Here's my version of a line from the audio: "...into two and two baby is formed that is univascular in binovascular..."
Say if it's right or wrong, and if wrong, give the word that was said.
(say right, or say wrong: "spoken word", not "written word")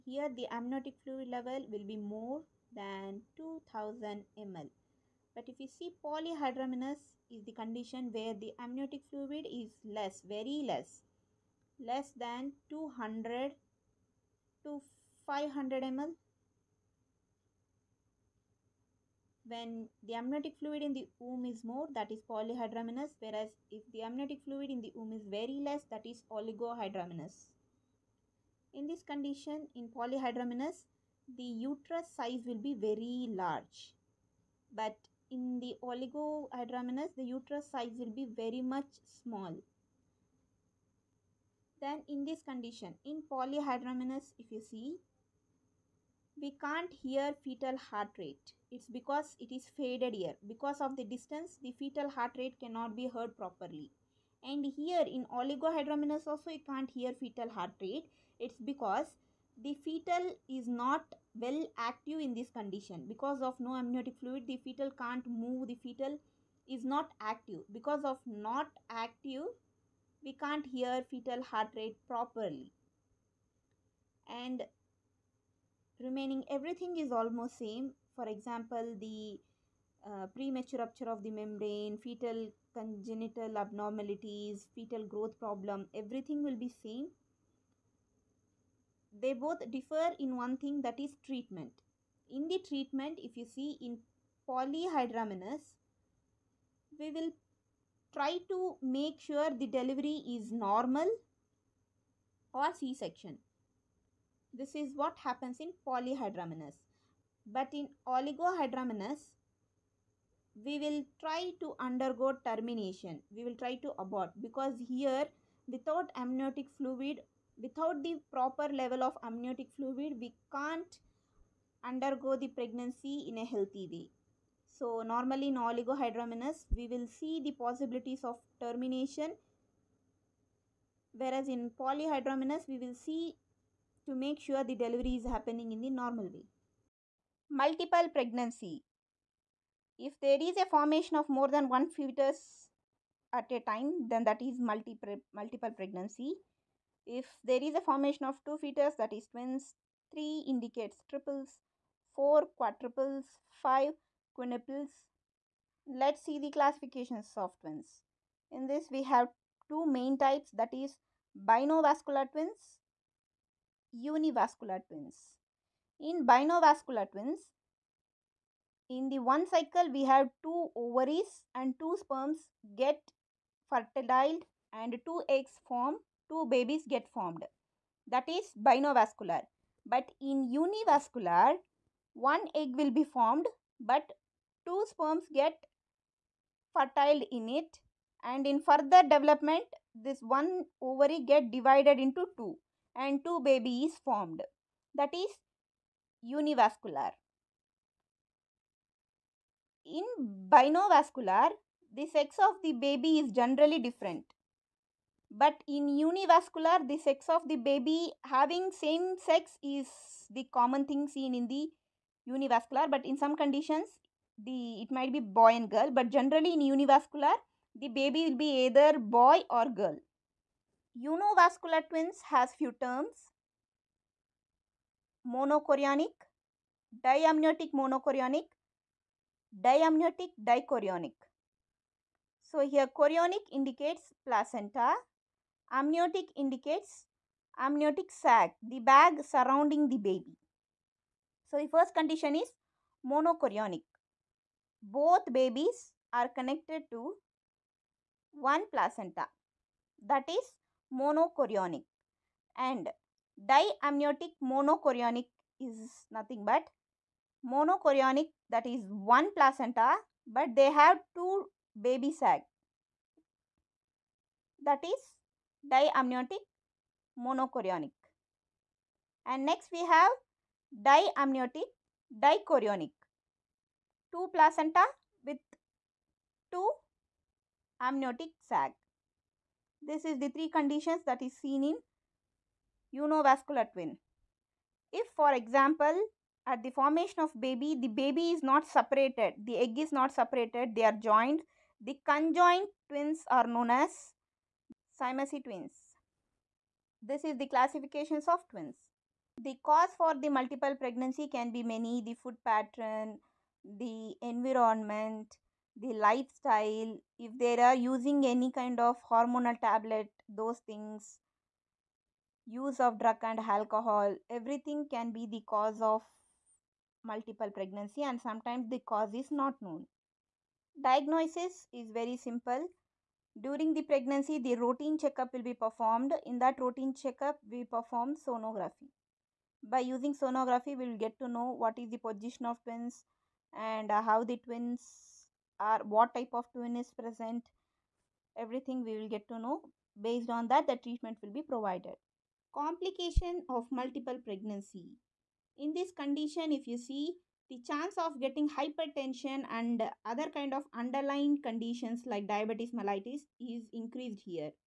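right.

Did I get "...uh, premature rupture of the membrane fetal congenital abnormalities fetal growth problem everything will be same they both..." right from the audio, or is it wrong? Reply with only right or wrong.
right.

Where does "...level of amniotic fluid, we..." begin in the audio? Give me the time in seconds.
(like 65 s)
118 s.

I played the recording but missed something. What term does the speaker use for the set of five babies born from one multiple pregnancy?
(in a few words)
quinuples.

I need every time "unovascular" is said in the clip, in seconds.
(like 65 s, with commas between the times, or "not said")
283 s.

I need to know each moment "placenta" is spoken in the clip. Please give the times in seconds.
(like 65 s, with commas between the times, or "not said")
234 s, 248 s, 259 s, 274 s.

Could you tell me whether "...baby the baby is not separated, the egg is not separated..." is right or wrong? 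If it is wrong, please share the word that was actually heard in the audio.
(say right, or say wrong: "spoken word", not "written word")
right.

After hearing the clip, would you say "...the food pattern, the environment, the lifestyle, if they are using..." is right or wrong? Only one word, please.
right.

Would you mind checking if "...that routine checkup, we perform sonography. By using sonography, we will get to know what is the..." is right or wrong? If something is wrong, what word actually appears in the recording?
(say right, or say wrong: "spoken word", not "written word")
right.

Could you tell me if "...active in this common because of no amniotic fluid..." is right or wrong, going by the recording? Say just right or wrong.
wrong.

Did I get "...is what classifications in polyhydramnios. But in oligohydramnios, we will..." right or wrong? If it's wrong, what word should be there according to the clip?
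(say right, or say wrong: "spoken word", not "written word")
wrong: "happens", not "classifications".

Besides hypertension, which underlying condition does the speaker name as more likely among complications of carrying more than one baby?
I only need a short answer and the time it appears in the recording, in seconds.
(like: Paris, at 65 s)
diabetes mellitus, at 352 s.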